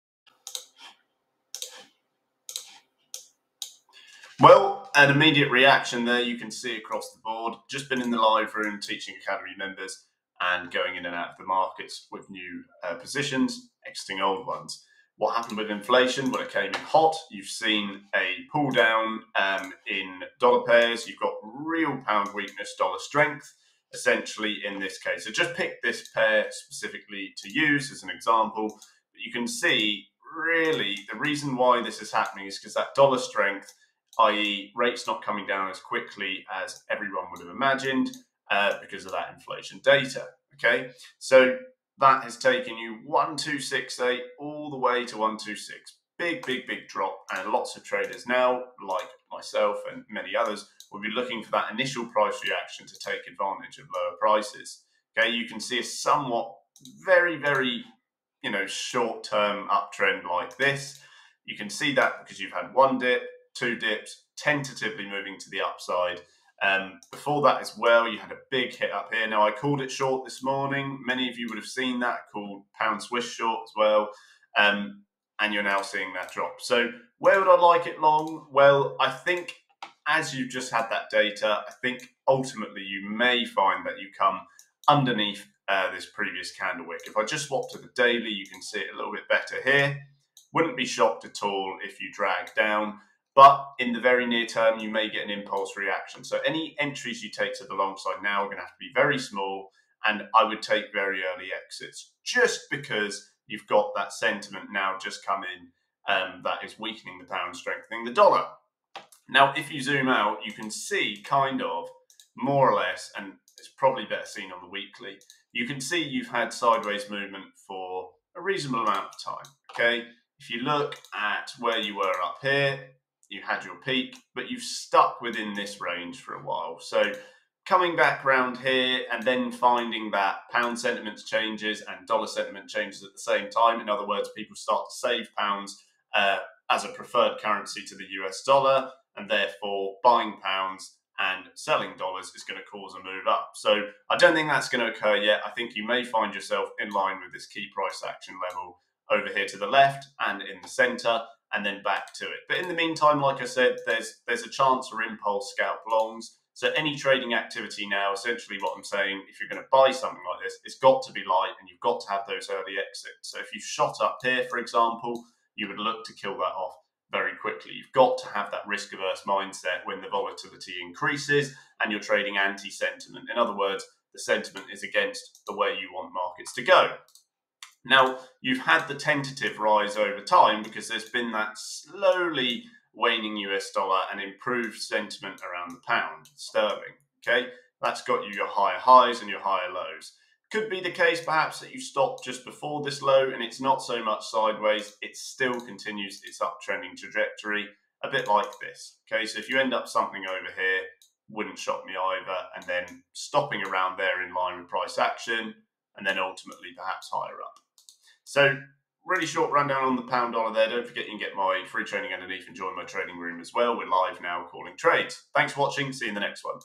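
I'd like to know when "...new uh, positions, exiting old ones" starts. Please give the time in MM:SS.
00:12.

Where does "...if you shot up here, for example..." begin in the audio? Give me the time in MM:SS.
02:43.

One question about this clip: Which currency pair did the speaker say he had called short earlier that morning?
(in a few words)
Pound Swiss.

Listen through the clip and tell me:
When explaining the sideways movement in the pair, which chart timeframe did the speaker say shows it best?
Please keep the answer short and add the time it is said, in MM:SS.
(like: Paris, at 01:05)
Weekly, at 01:54.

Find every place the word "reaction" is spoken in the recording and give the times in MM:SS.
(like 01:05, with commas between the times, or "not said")
00:05, 00:52, 01:35.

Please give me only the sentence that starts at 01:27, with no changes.
If I just swap to the daily, you can see it a little bit better here.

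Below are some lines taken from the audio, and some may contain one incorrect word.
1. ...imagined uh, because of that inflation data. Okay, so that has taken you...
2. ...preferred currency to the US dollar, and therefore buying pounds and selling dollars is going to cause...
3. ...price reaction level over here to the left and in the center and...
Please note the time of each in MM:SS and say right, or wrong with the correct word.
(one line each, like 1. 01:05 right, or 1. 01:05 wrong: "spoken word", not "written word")
1. 00:37 right
2. 02:16 right
3. 02:27 wrong: "action", not "reaction".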